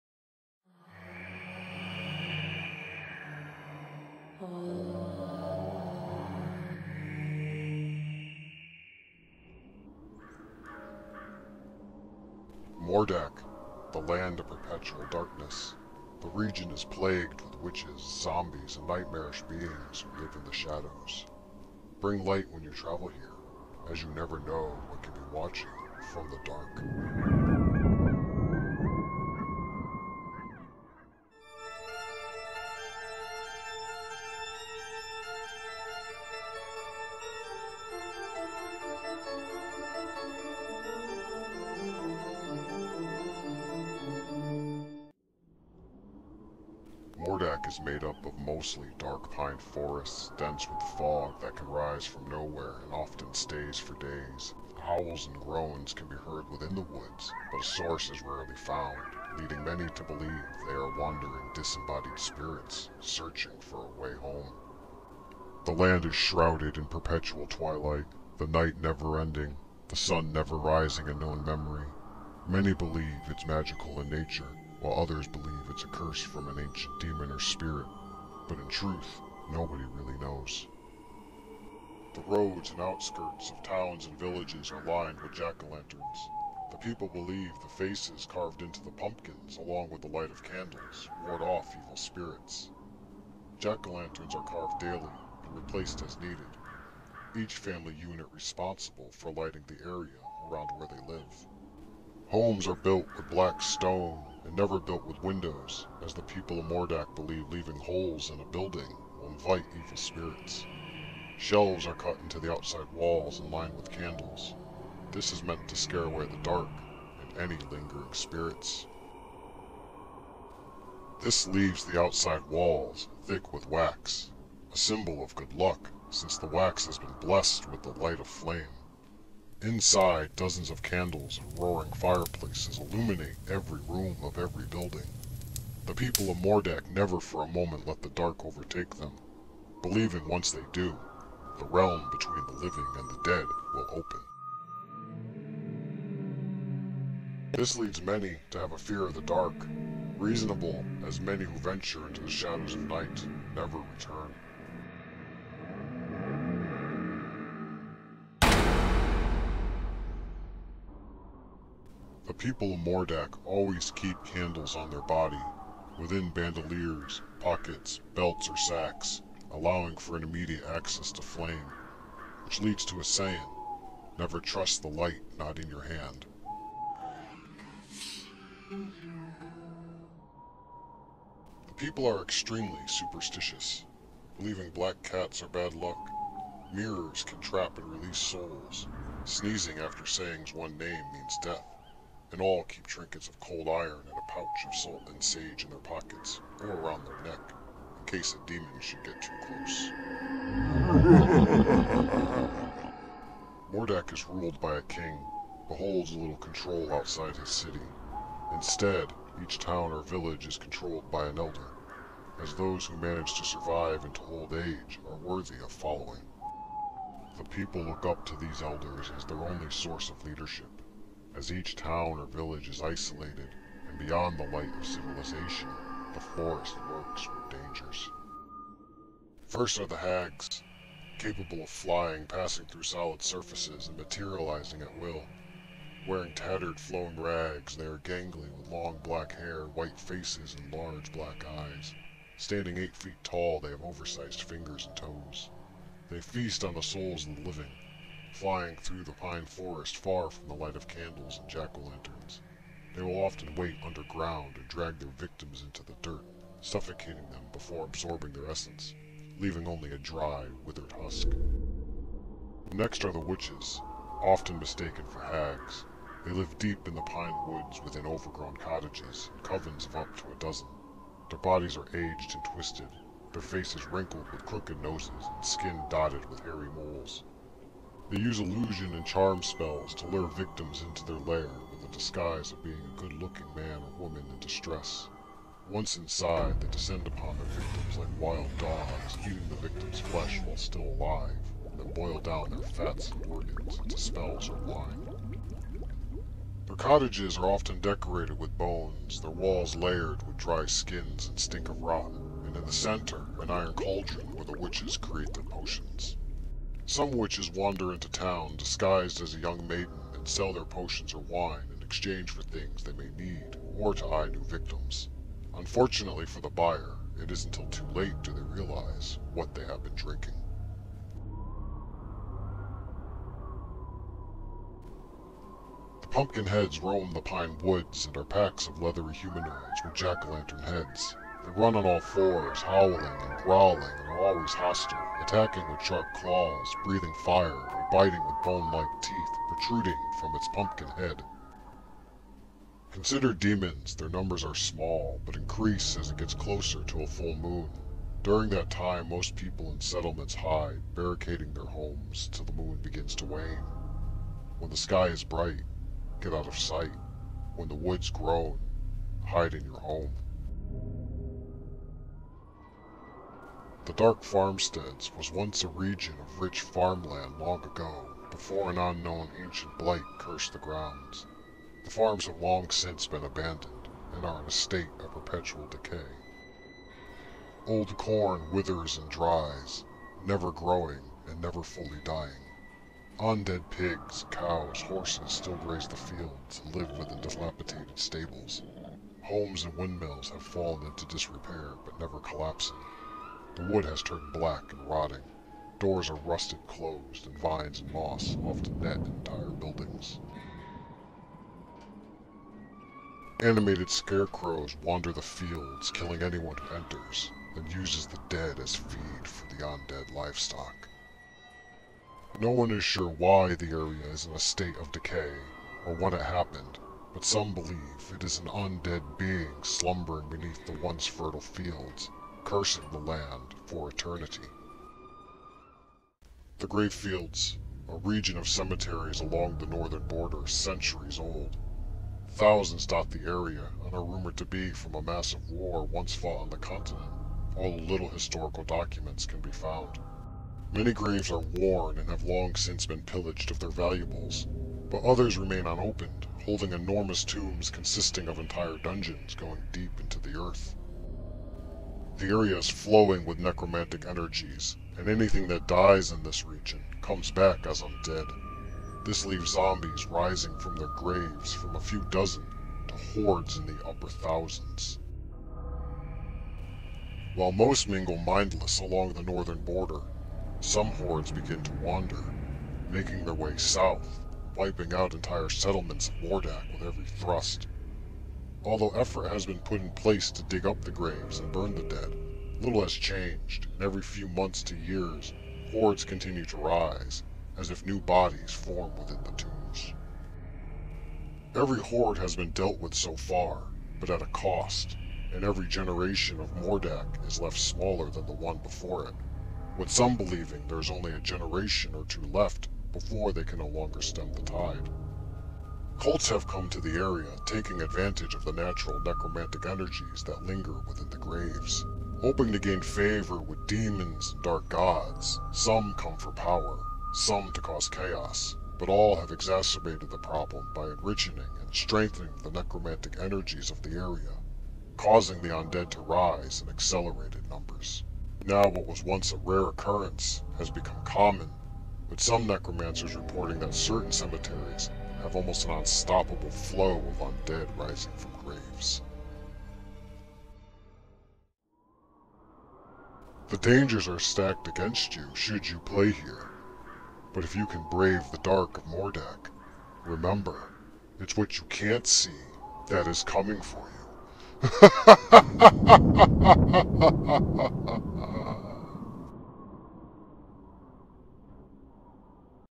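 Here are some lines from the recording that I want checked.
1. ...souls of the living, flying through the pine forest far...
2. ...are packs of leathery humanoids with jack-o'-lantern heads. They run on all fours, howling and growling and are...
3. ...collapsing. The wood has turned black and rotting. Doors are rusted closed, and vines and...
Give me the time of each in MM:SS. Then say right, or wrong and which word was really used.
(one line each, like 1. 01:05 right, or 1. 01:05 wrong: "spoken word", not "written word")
1. 04:06 right
2. 05:28 right
3. 06:32 right.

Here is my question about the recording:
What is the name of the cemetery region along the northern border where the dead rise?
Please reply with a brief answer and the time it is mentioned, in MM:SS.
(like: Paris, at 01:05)
The Grave Fields, at 07:06.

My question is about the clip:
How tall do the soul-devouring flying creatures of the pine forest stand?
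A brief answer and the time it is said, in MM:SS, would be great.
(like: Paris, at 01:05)
Eight feet, at 04:02.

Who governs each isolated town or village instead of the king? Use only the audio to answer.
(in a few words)
An elder.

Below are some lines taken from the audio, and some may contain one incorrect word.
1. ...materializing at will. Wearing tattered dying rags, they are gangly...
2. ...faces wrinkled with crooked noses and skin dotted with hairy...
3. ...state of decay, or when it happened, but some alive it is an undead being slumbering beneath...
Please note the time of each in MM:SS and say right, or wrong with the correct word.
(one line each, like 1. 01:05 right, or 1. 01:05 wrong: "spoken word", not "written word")
1. 03:53 wrong: "flowing", not "dying"
2. 04:33 right
3. 06:54 wrong: "believe", not "alive".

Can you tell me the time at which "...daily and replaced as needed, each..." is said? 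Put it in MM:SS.
01:34.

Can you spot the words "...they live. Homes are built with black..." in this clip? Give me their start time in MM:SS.
01:40.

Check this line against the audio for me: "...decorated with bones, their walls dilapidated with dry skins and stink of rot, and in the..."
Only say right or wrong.
wrong.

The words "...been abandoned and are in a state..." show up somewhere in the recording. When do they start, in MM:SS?
06:13.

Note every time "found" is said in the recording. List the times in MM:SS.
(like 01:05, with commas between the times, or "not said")
00:58, 07:19.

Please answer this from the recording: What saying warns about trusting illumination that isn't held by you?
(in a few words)
Never trust the light not in your hand.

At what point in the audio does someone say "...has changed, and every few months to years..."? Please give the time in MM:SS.
08:02.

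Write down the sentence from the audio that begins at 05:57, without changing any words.
When the woods groan, hide in your home.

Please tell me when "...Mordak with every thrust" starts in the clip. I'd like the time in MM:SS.
07:56.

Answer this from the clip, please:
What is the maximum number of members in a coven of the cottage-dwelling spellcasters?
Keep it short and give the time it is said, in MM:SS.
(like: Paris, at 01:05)
A dozen, at 04:30.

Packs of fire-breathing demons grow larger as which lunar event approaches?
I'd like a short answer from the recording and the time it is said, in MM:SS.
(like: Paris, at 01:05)
A full moon, at 05:47.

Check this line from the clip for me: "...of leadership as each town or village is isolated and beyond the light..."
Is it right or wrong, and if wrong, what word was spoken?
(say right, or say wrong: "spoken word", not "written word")
right.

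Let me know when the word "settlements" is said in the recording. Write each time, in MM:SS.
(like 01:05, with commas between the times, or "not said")
05:49, 07:55.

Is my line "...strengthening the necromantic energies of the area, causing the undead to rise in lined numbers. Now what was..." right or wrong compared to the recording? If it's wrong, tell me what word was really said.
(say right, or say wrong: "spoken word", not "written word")
wrong: "accelerated", not "lined".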